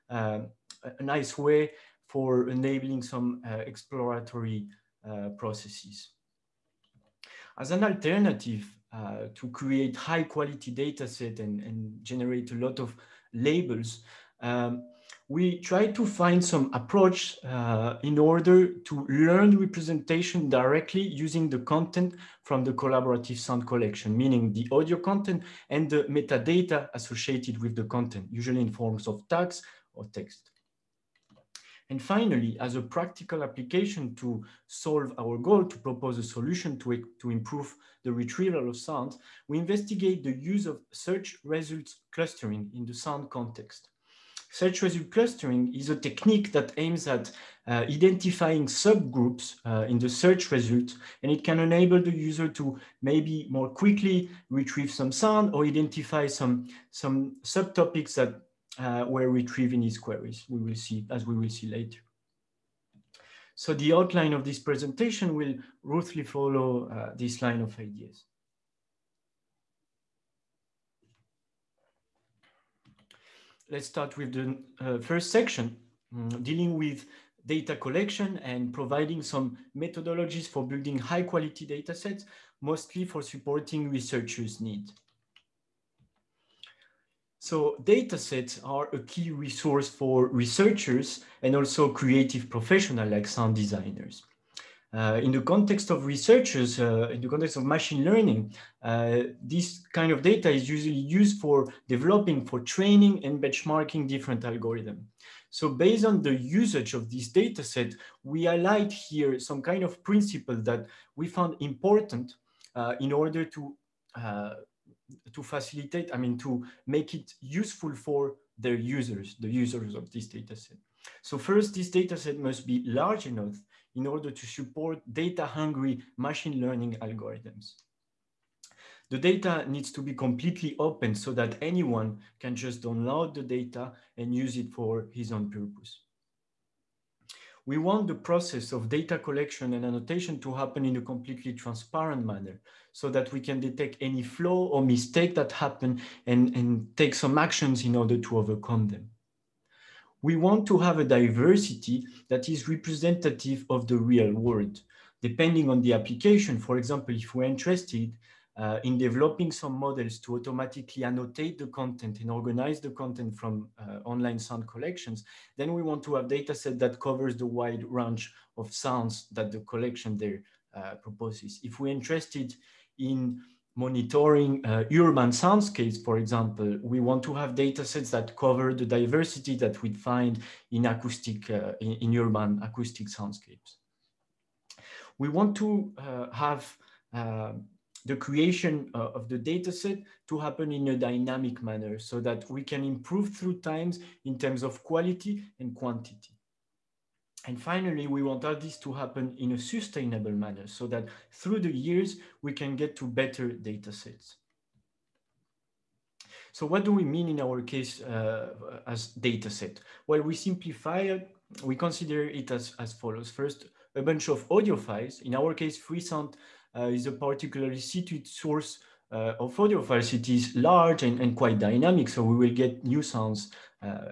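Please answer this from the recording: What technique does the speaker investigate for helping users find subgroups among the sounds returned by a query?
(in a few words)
Search results clustering.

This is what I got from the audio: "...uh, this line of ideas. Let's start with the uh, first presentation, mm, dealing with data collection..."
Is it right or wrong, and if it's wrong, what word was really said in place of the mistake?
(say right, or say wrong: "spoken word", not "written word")
wrong: "section", not "presentation".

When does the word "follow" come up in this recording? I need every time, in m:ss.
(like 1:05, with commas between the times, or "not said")
1:06, 3:32.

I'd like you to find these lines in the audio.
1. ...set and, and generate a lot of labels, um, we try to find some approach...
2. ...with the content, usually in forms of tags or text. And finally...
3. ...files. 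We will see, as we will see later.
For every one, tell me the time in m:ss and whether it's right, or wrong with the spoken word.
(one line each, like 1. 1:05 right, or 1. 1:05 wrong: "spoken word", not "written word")
1. 0:11 right
2. 0:27 right
3. 0:59 wrong: "queries", not "files".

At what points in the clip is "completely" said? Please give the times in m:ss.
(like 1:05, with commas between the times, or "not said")
2:10, 2:21.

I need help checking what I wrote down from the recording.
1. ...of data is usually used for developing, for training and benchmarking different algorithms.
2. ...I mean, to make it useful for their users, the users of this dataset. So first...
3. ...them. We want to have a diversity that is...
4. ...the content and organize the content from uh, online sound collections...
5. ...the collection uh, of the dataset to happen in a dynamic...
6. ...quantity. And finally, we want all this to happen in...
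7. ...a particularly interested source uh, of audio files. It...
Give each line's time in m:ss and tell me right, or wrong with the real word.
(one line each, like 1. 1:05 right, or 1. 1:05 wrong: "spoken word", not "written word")
1. 1:40 right
2. 1:56 right
3. 2:28 right
4. 2:41 right
5. 3:08 wrong: "creation", not "collection"
6. 3:15 right
7. 3:37 wrong: "suited", not "interested".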